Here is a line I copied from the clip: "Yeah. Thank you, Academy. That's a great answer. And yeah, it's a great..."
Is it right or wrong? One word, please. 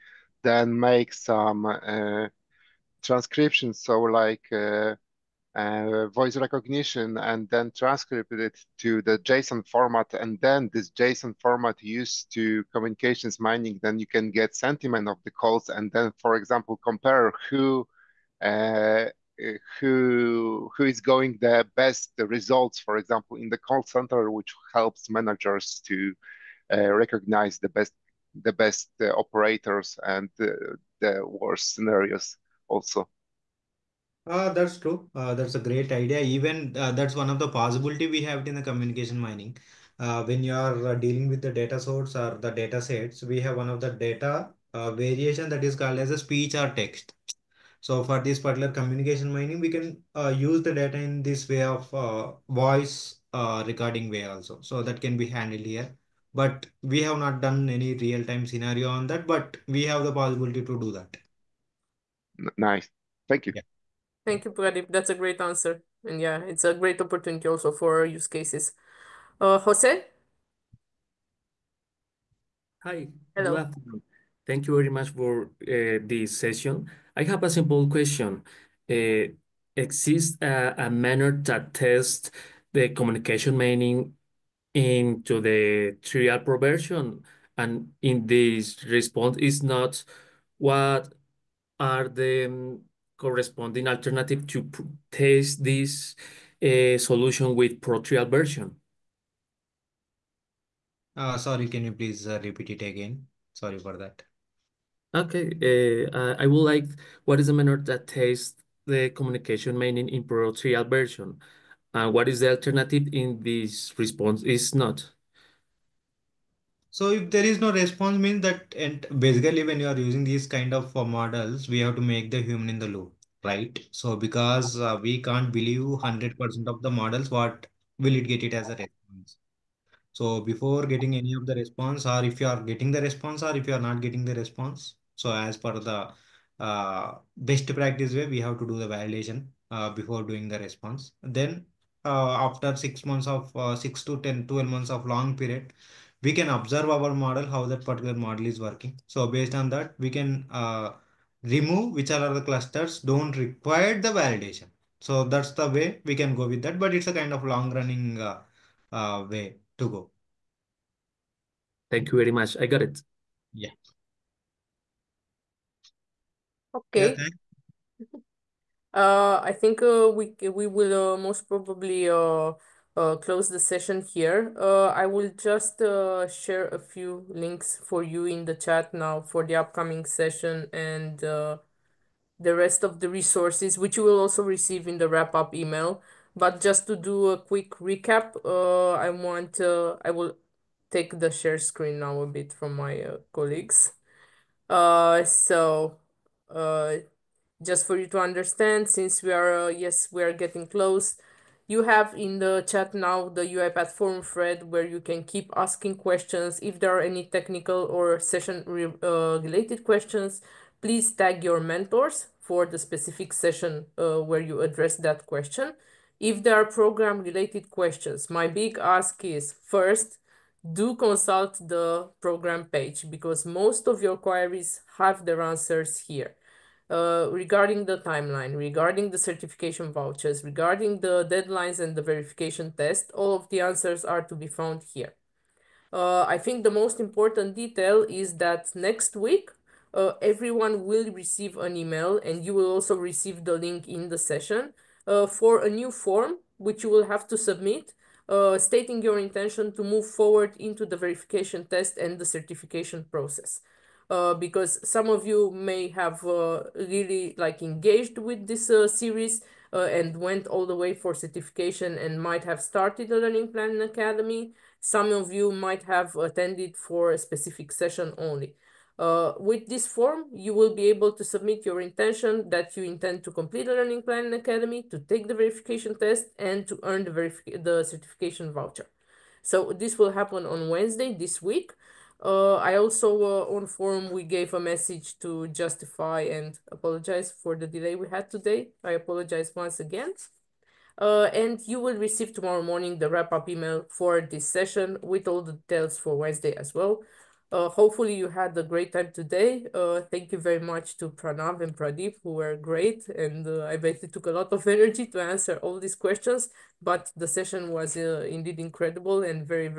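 wrong.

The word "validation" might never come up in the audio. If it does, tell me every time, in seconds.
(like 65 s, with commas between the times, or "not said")
138 s, 154 s.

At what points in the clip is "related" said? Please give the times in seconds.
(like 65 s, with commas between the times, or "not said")
209 s, 217 s.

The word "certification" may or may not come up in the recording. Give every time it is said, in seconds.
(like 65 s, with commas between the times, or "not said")
229 s, 252 s, 261 s, 277 s.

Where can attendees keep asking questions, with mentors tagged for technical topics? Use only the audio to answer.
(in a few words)
UiPath forum thread.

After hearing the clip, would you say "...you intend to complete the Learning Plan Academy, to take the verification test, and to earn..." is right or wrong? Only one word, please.
right.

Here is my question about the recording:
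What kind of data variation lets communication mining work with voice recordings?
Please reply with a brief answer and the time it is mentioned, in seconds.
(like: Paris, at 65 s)
speech or text, at 46 s.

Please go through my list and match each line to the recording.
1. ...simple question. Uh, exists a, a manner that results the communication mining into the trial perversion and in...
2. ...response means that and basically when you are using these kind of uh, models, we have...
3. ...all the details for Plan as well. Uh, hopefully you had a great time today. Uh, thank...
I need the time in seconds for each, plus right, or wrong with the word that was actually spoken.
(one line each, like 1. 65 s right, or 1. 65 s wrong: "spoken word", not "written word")
1. 77 s wrong: "tests", not "results"
2. 117 s right
3. 295 s wrong: "Wednesday", not "Plan".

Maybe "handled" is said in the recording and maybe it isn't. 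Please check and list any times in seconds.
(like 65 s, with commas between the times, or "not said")
55 s.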